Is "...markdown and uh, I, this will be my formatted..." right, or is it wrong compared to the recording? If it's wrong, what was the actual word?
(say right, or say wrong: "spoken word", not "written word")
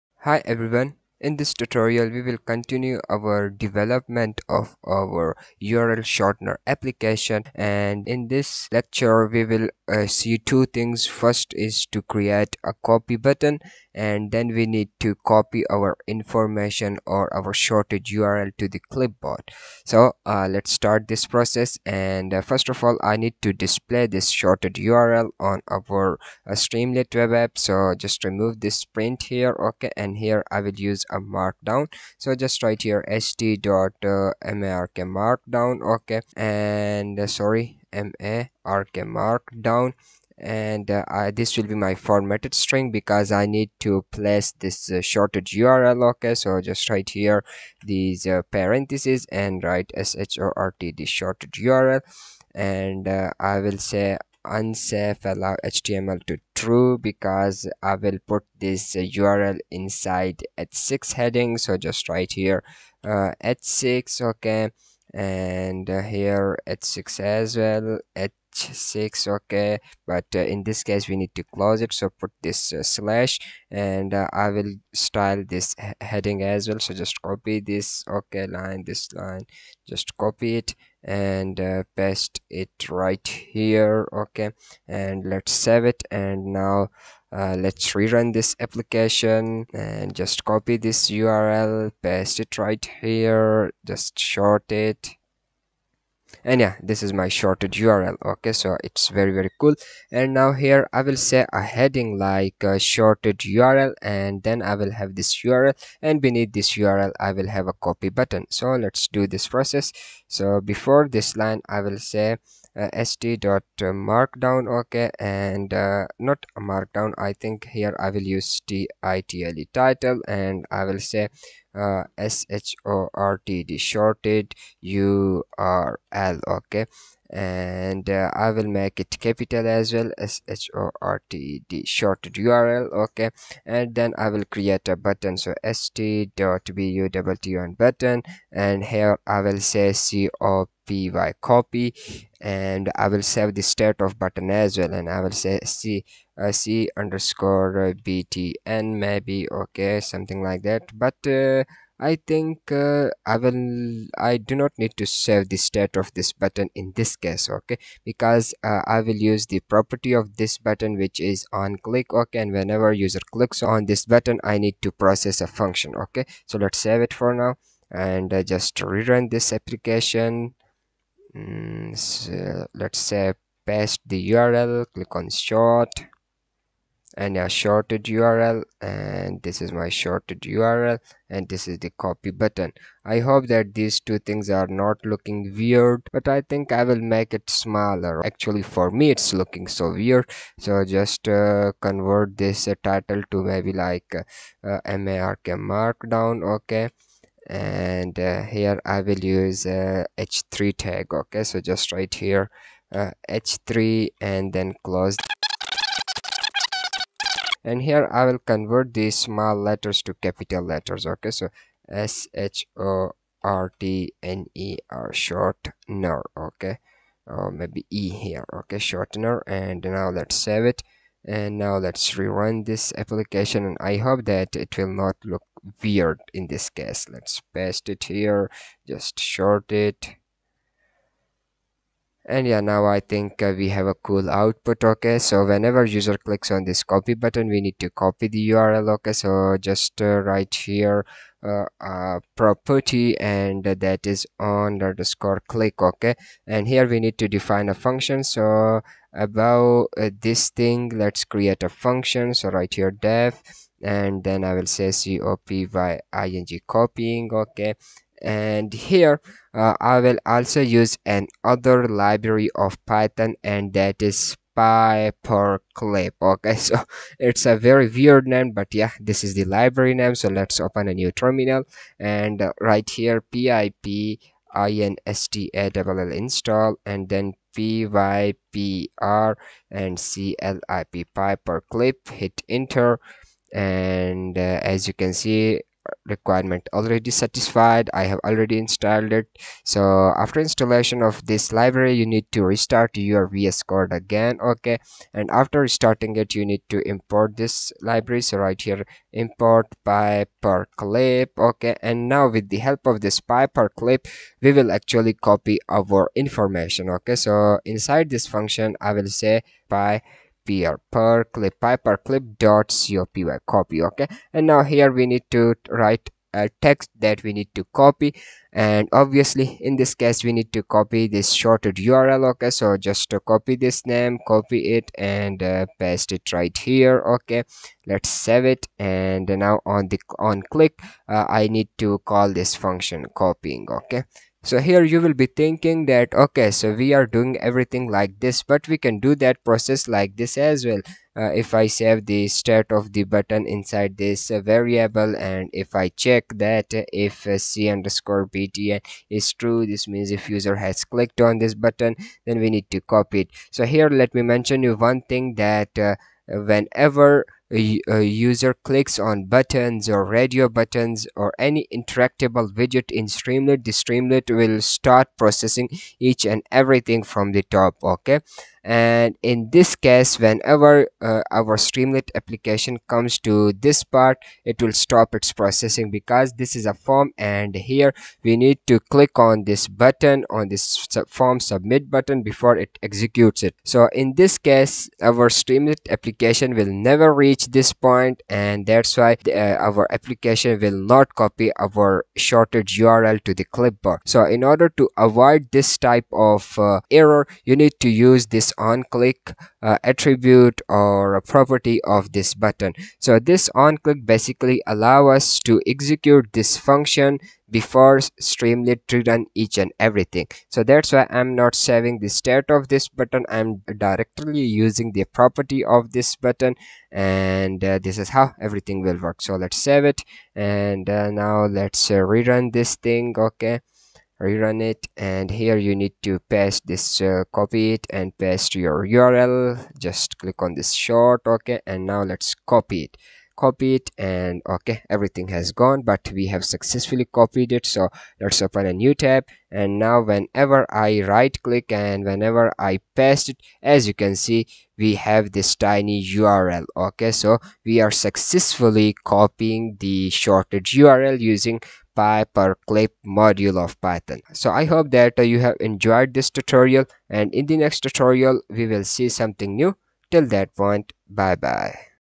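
right.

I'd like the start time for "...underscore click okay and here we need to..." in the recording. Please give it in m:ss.
4:04.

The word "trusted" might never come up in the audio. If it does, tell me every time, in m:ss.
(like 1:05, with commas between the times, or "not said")
not said.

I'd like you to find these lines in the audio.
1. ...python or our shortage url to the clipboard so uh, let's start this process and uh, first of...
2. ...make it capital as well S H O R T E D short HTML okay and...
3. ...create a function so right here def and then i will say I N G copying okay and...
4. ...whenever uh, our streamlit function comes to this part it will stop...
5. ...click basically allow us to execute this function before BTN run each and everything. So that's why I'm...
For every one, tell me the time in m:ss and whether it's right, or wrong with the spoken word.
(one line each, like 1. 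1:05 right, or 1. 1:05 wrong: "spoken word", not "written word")
1. 0:16 wrong: "information", not "python"
2. 2:08 wrong: "URL", not "HTML"
3. 4:11 right
4. 6:10 wrong: "application", not "function"
5. 6:43 wrong: "Streamlit", not "BTN".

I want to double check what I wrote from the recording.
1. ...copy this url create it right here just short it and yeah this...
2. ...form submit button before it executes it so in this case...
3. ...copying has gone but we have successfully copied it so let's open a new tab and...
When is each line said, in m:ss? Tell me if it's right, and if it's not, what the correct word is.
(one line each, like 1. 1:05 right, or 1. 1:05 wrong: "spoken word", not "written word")
1. 1:30 wrong: "paste", not "create"
2. 6:21 right
3. 7:14 wrong: "everything", not "copying".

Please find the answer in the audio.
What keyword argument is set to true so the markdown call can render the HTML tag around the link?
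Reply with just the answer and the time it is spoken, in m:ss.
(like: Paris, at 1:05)
unsafe allow HTML, at 0:54.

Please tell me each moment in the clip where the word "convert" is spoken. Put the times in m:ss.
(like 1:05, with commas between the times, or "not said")
3:11, 3:28.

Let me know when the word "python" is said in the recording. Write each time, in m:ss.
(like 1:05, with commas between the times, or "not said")
4:22, 7:33.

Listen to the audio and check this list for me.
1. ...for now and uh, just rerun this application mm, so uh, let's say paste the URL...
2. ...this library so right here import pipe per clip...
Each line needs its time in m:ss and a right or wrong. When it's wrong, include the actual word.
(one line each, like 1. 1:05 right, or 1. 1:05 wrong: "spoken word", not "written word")
1. 2:47 right
2. 4:57 right.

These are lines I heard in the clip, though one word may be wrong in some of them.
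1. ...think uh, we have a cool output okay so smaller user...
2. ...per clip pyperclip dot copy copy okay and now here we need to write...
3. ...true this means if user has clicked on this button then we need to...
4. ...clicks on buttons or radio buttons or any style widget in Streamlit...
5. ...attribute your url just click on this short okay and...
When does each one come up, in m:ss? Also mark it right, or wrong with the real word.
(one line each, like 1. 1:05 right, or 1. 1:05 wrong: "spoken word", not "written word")
1. 3:53 wrong: "whenever", not "smaller"
2. 5:10 right
3. 5:49 right
4. 5:58 wrong: "interactable", not "style"
5. 7:08 wrong: "paste", not "attribute".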